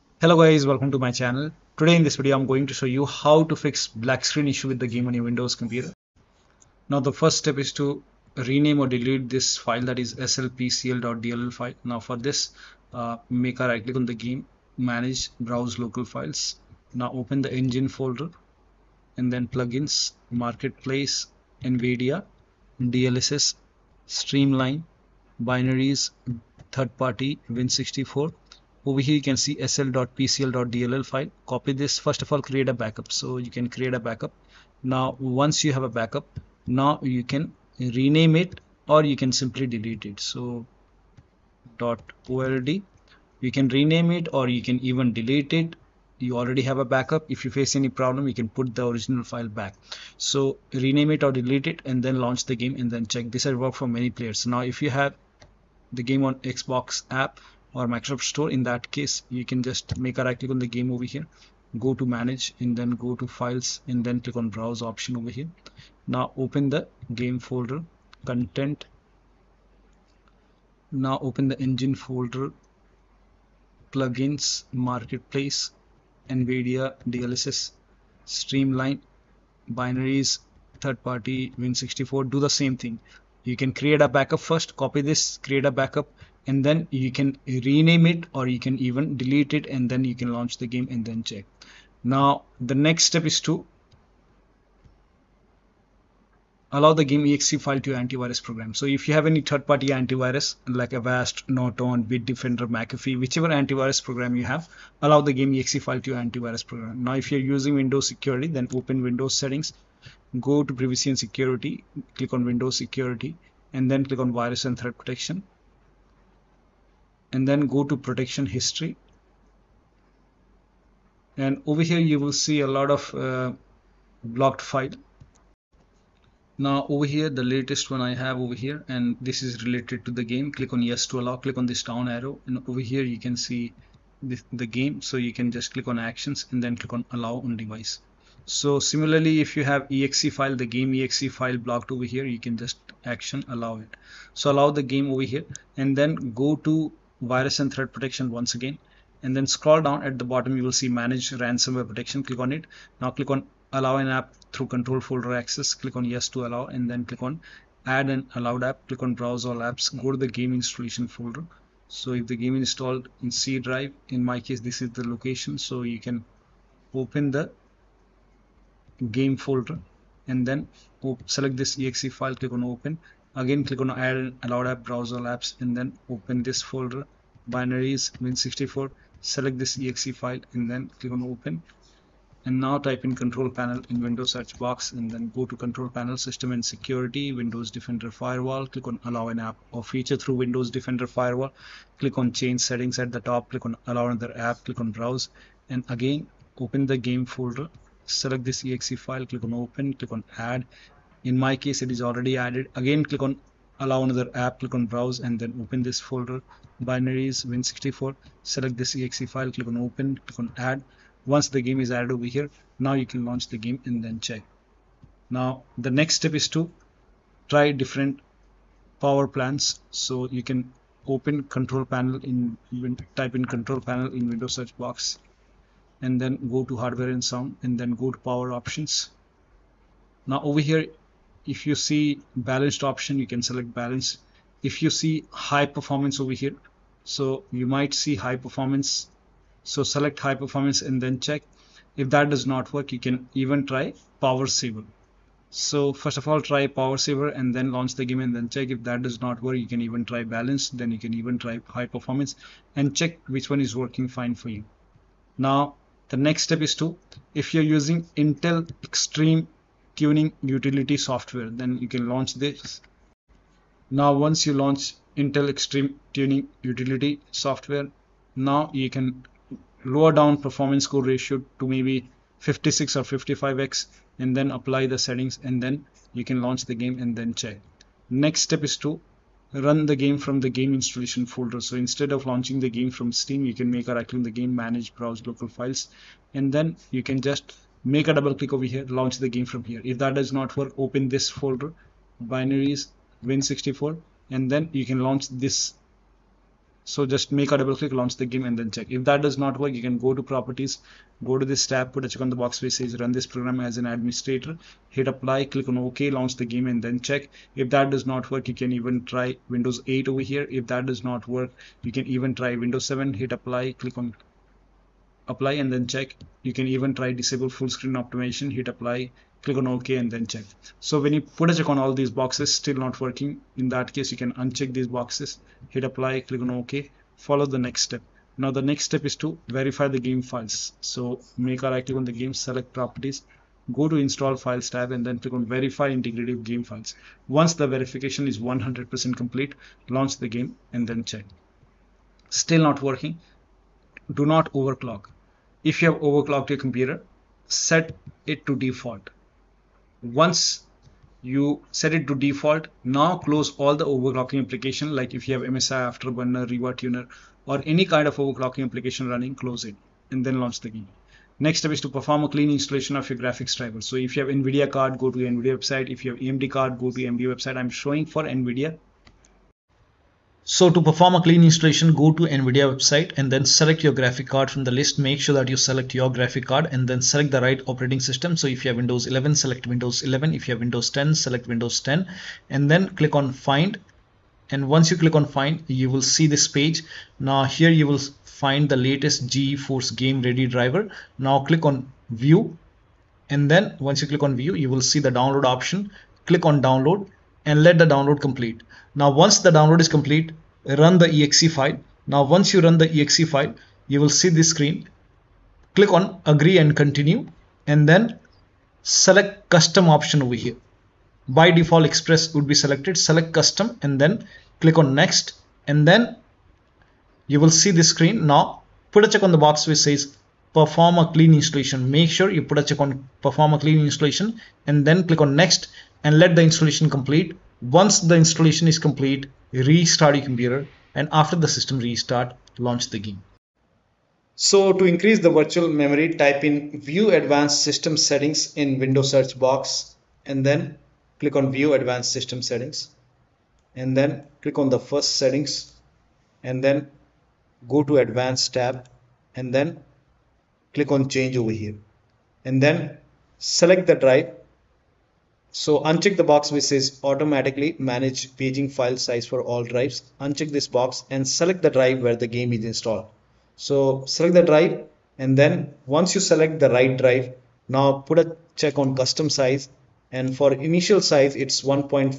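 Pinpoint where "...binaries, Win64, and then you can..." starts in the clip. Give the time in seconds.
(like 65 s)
292 s.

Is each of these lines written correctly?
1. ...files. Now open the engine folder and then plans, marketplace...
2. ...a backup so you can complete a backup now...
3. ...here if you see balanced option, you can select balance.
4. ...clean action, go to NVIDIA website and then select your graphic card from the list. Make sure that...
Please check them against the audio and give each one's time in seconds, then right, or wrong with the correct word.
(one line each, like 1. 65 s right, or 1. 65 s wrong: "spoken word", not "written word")
1. 16 s wrong: "plugins", not "plans"
2. 32 s wrong: "create", not "complete"
3. 230 s right
4. 371 s wrong: "installation", not "action".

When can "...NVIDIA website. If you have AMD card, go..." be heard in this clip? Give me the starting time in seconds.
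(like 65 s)
365 s.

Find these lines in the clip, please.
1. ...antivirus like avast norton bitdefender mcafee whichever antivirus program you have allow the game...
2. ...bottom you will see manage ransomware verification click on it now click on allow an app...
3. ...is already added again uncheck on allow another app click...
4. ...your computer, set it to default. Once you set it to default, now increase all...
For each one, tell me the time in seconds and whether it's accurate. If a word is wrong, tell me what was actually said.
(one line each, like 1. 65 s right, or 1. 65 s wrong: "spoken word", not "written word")
1. 99 s right
2. 150 s wrong: "protection", not "verification"
3. 201 s wrong: "click", not "uncheck"
4. 346 s wrong: "close", not "increase".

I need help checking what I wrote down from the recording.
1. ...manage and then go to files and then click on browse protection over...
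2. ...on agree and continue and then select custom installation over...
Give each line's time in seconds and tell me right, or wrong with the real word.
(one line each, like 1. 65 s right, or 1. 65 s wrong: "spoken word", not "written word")
1. 62 s wrong: "option", not "protection"
2. 405 s wrong: "option", not "installation".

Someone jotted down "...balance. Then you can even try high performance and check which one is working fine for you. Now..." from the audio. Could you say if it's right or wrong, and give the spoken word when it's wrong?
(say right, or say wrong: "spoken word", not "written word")
right.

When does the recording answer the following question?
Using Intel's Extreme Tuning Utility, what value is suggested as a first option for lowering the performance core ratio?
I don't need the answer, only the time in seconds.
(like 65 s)
272 s.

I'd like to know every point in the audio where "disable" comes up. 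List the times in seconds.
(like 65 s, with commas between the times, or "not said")
317 s.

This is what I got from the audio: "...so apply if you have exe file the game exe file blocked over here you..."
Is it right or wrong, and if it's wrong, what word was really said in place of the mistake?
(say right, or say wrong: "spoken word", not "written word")
wrong: "similarly", not "apply".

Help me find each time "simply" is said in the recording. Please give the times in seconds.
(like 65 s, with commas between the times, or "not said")
39 s.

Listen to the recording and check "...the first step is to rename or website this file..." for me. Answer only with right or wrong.
wrong.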